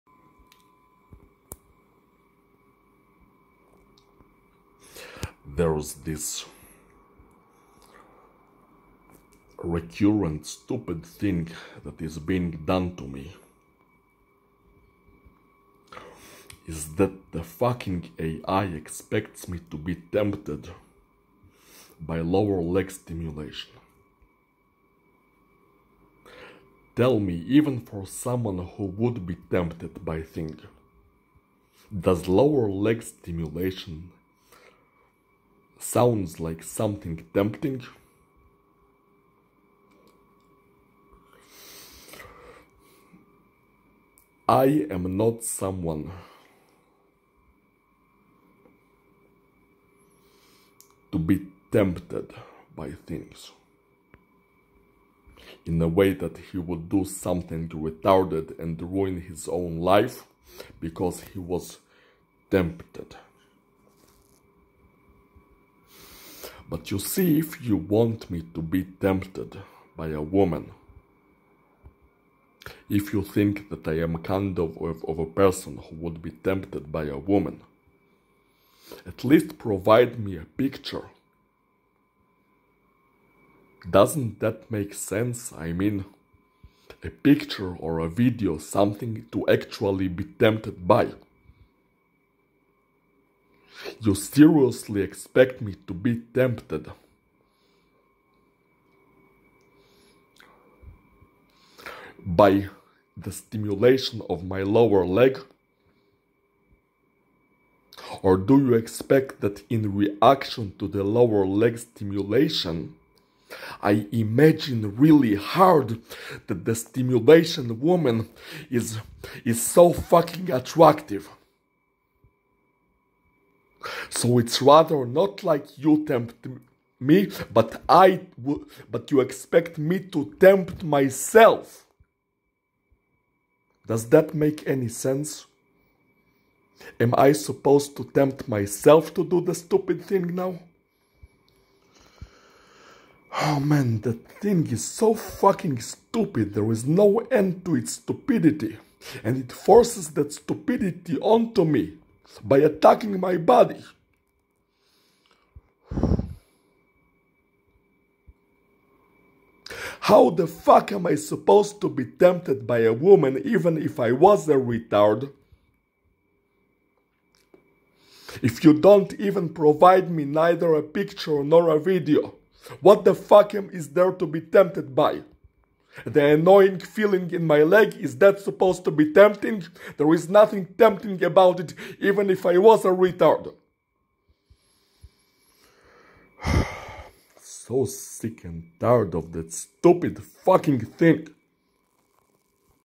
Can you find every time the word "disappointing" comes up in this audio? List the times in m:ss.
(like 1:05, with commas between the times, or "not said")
not said.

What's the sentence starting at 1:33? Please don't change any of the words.
You seriously expect me to be tempted?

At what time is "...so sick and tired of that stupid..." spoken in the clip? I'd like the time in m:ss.
3:07.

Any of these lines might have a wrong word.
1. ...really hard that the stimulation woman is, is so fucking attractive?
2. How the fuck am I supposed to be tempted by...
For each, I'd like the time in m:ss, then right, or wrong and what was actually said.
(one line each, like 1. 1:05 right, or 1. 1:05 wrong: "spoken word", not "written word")
1. 1:54 right
2. 2:40 right.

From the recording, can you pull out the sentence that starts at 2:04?
So it's rather not like you tempt me, but I, but you expect me to tempt myself.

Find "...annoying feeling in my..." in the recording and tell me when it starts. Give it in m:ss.
2:56.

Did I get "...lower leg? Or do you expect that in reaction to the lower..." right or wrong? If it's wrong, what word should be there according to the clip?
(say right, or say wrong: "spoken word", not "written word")
right.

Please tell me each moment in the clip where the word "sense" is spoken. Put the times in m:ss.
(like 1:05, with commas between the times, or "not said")
1:24, 2:14.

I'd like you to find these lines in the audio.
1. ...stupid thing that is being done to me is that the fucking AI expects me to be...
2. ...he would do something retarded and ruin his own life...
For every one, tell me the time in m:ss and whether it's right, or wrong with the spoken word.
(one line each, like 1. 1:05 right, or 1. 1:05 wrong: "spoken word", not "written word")
1. 0:10 right
2. 0:56 right.